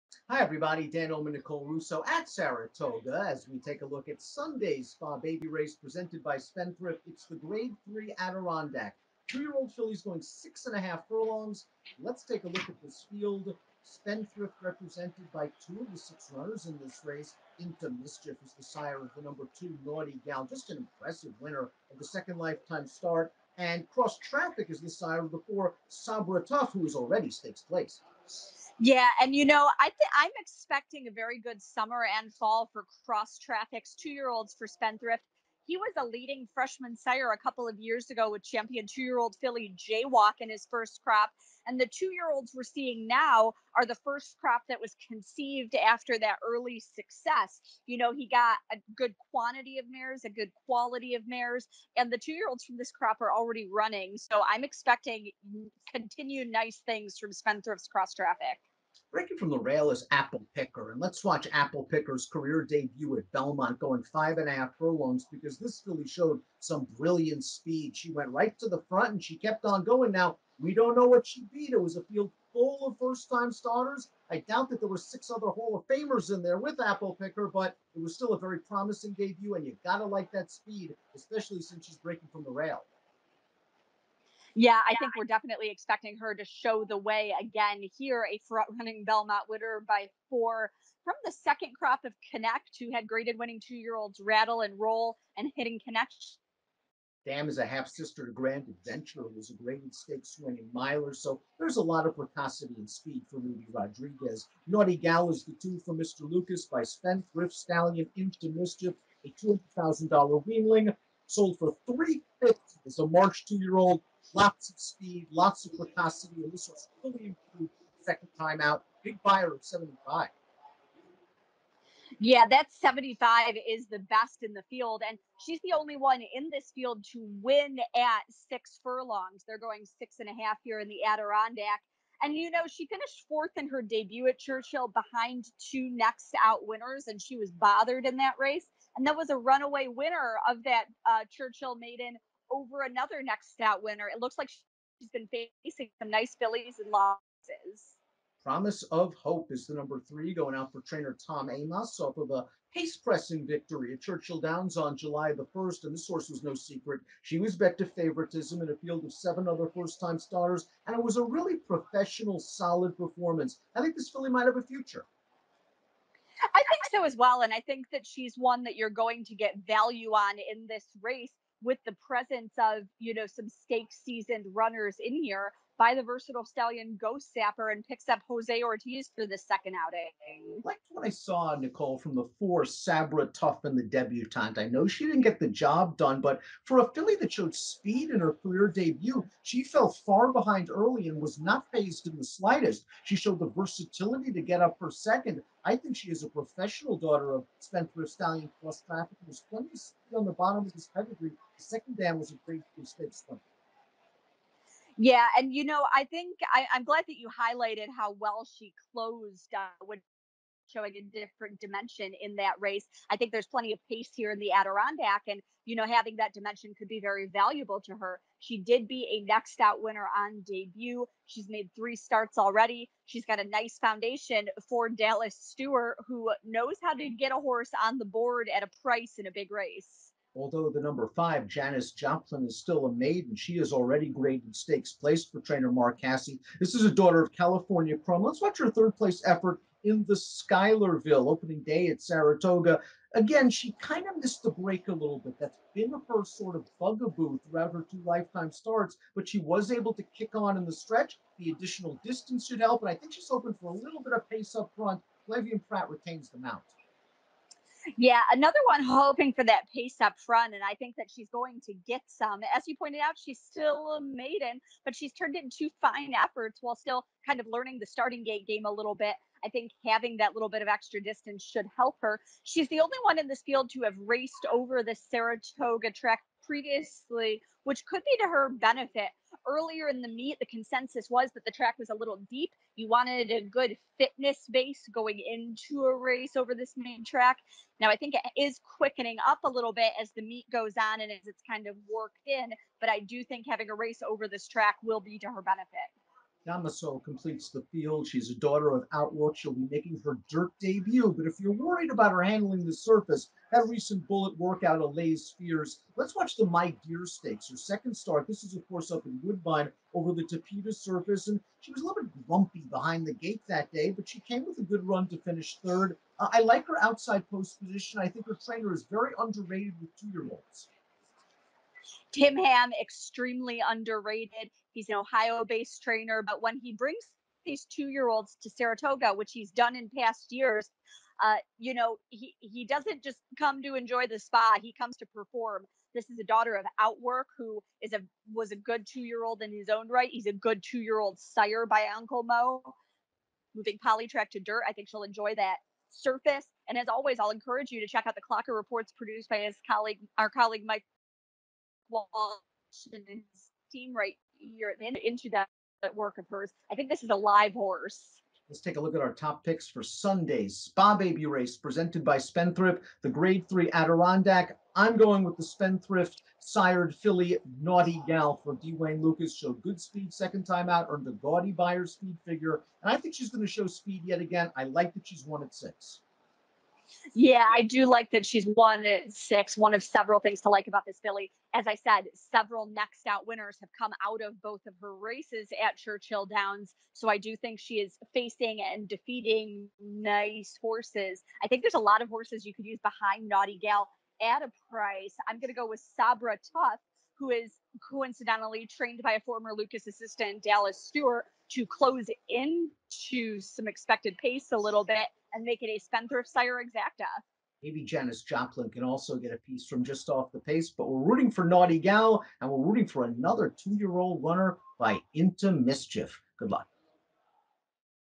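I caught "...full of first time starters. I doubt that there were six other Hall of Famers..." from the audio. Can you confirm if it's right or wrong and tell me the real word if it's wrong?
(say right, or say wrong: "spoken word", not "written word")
right.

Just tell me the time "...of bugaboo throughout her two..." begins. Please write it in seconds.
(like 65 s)
246 s.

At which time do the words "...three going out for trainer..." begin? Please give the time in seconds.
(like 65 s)
150 s.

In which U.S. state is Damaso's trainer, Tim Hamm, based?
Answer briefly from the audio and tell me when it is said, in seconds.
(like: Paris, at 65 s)
Ohio, at 324 s.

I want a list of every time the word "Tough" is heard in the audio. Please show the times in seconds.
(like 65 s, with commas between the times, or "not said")
26 s, 396 s.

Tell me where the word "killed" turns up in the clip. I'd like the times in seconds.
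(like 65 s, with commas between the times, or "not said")
not said.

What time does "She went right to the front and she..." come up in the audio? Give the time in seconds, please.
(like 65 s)
67 s.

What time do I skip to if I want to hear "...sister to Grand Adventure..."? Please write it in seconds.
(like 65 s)
97 s.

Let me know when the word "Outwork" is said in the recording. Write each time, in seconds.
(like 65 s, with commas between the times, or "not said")
298 s, 336 s.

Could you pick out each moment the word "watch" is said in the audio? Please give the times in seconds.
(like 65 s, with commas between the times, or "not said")
61 s, 238 s, 306 s.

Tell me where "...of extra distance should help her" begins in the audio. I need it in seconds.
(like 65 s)
270 s.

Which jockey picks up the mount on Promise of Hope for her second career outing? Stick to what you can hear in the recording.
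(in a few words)
Jose Ortiz.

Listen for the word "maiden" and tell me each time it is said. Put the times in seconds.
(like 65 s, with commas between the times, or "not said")
141 s, 232 s, 264 s.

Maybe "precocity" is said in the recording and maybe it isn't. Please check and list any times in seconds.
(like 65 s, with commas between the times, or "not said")
102 s, 115 s.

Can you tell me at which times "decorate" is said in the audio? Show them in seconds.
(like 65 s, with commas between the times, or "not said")
not said.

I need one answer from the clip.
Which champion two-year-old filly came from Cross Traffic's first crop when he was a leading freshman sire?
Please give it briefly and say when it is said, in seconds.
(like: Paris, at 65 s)
Jaywalk, at 39 s.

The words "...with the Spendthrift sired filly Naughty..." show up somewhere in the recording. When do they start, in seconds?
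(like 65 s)
365 s.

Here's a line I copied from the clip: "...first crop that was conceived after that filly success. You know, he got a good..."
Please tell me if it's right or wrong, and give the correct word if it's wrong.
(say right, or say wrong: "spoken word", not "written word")
wrong: "early", not "filly".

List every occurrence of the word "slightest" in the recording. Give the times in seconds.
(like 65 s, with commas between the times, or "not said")
192 s.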